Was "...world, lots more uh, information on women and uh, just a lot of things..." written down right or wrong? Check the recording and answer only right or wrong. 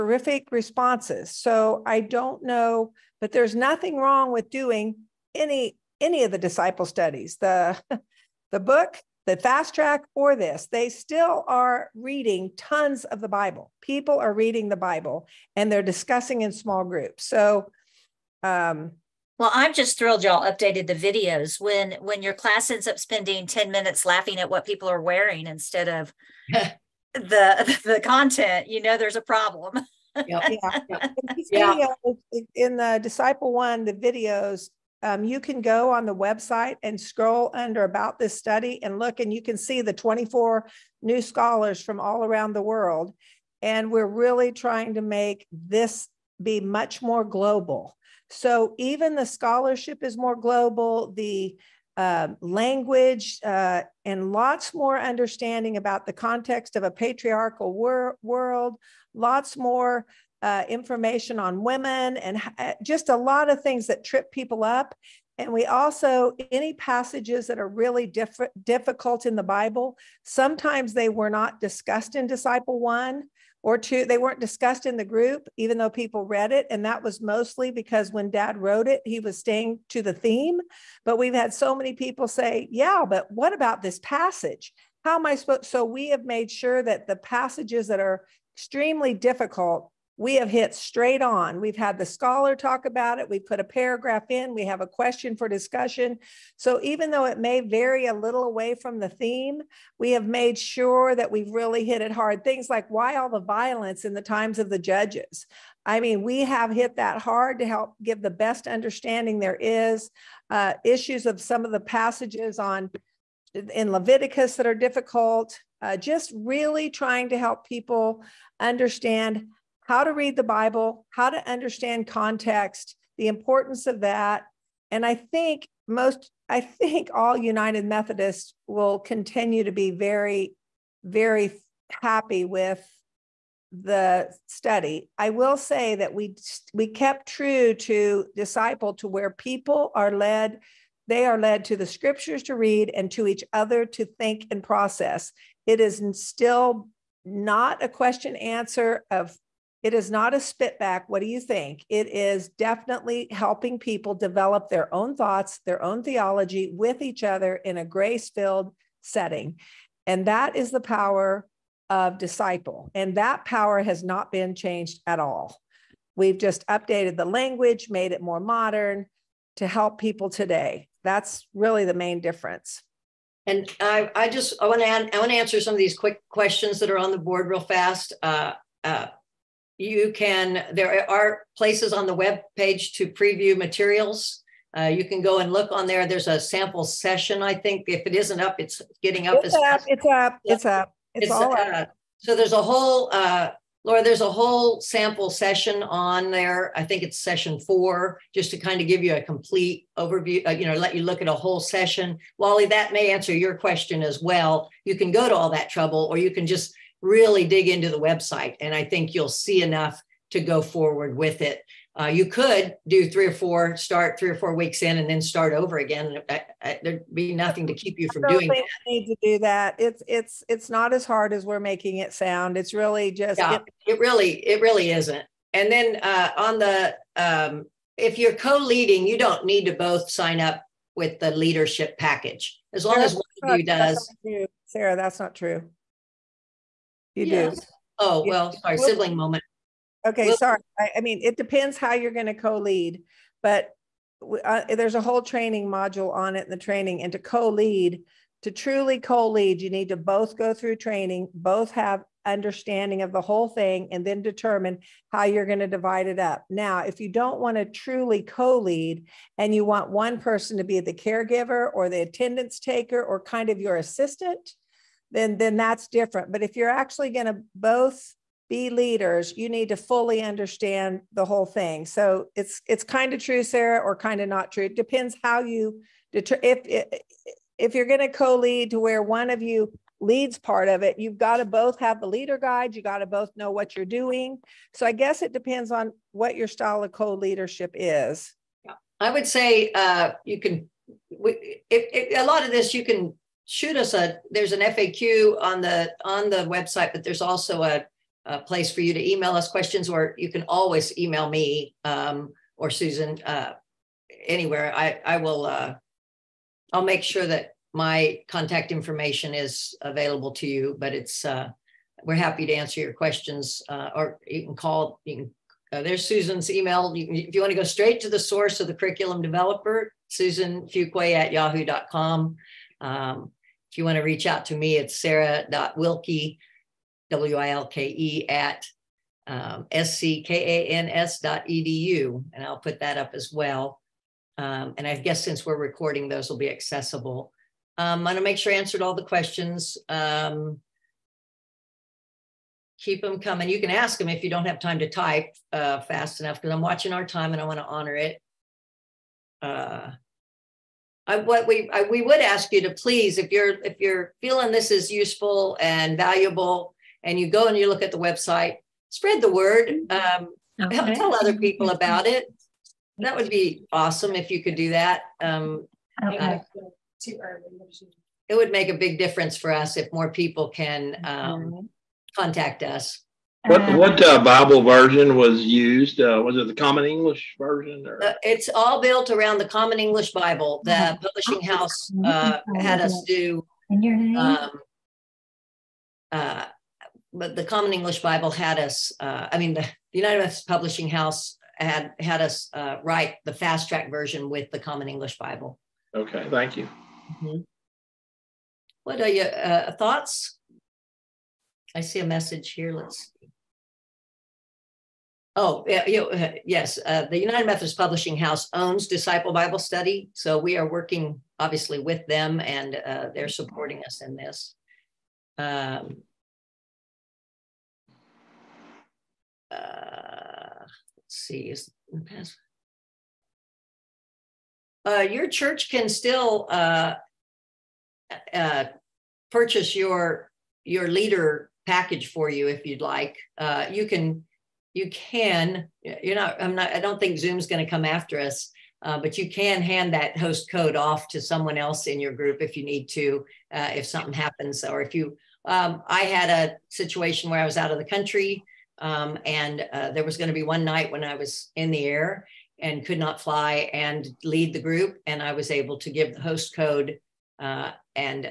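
right.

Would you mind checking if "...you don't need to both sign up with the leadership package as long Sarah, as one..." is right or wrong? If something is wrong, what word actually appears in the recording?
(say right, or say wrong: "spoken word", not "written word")
right.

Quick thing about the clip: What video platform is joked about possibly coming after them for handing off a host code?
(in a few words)
Zoom.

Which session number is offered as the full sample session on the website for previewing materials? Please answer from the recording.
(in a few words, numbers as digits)
session four.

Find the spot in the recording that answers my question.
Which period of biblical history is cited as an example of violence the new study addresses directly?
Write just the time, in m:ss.
1:44.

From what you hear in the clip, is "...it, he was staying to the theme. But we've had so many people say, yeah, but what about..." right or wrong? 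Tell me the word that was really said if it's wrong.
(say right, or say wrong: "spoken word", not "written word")
right.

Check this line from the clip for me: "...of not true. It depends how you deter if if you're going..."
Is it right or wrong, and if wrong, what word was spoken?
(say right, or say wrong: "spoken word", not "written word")
right.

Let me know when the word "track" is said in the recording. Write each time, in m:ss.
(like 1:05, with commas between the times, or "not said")
0:09, 6:33.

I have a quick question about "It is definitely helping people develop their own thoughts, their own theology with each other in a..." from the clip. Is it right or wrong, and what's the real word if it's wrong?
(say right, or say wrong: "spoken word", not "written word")
right.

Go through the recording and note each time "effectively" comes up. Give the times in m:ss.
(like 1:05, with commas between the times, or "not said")
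not said.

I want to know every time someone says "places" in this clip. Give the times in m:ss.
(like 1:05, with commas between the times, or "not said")
3:01, 4:58.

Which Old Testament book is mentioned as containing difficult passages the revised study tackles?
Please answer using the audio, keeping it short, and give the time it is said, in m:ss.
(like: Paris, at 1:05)
Leviticus, at 1:53.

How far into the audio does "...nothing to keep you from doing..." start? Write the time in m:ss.
3:37.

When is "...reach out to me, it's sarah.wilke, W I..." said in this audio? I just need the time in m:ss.
5:24.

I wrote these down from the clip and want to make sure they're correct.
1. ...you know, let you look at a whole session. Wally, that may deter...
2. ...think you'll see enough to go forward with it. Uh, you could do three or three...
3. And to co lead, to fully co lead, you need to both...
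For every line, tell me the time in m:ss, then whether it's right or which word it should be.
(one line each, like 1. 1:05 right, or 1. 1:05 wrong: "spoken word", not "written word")
1. 3:20 wrong: "answer", not "deter"
2. 3:28 wrong: "four", not "three"
3. 4:07 wrong: "truly", not "fully".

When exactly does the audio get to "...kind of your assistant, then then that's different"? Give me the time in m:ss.
4:23.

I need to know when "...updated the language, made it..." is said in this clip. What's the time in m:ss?
2:46.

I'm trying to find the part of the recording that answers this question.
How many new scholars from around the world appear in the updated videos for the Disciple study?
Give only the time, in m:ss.
0:39.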